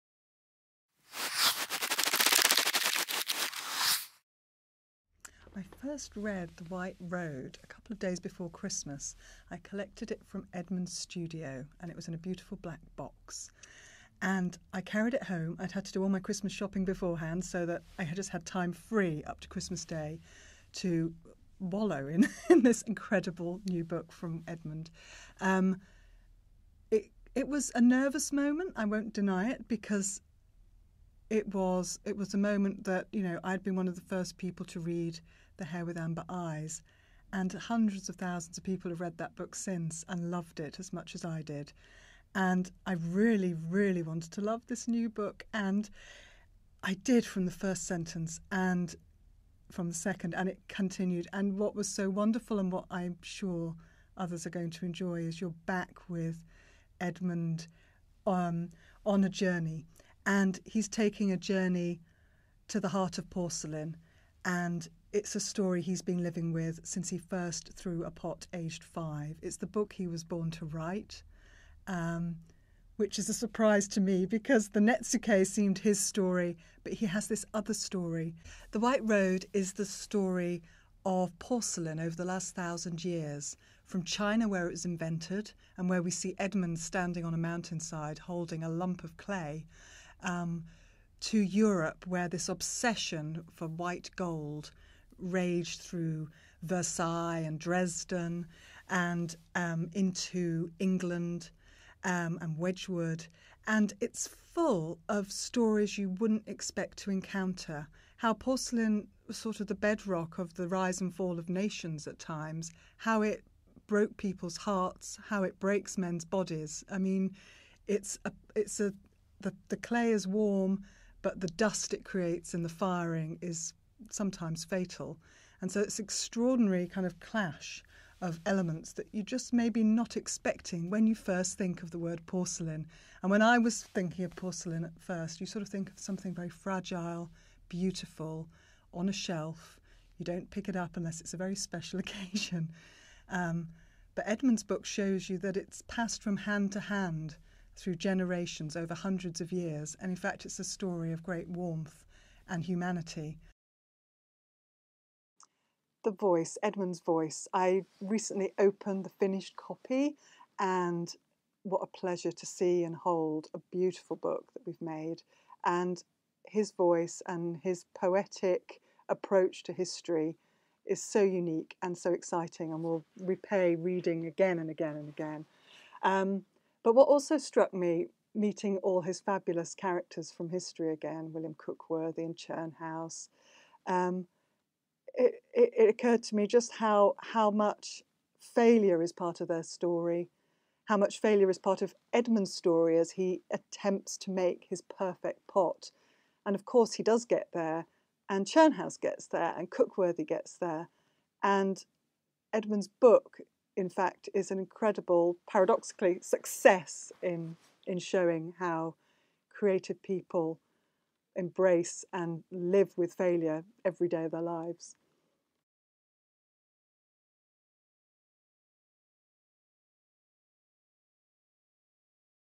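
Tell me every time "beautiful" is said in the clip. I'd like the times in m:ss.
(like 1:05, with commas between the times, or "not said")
0:12, 2:17, 2:43.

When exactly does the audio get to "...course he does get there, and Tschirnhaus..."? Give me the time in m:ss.
3:16.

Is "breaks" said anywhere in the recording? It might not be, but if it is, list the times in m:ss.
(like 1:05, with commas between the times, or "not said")
1:55.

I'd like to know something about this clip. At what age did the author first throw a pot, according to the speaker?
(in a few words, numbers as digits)
5.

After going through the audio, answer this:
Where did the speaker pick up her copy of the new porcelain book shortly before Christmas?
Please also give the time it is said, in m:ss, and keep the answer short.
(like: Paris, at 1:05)
Edmund's studio, at 0:10.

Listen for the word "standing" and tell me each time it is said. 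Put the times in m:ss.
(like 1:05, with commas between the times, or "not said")
1:26.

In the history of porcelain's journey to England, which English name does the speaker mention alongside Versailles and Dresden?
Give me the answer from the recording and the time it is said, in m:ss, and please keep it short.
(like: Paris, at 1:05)
Wedgwood, at 1:42.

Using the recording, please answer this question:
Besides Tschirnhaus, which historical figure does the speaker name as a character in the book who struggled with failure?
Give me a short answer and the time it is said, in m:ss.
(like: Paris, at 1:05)
William Cookworthy, at 3:01.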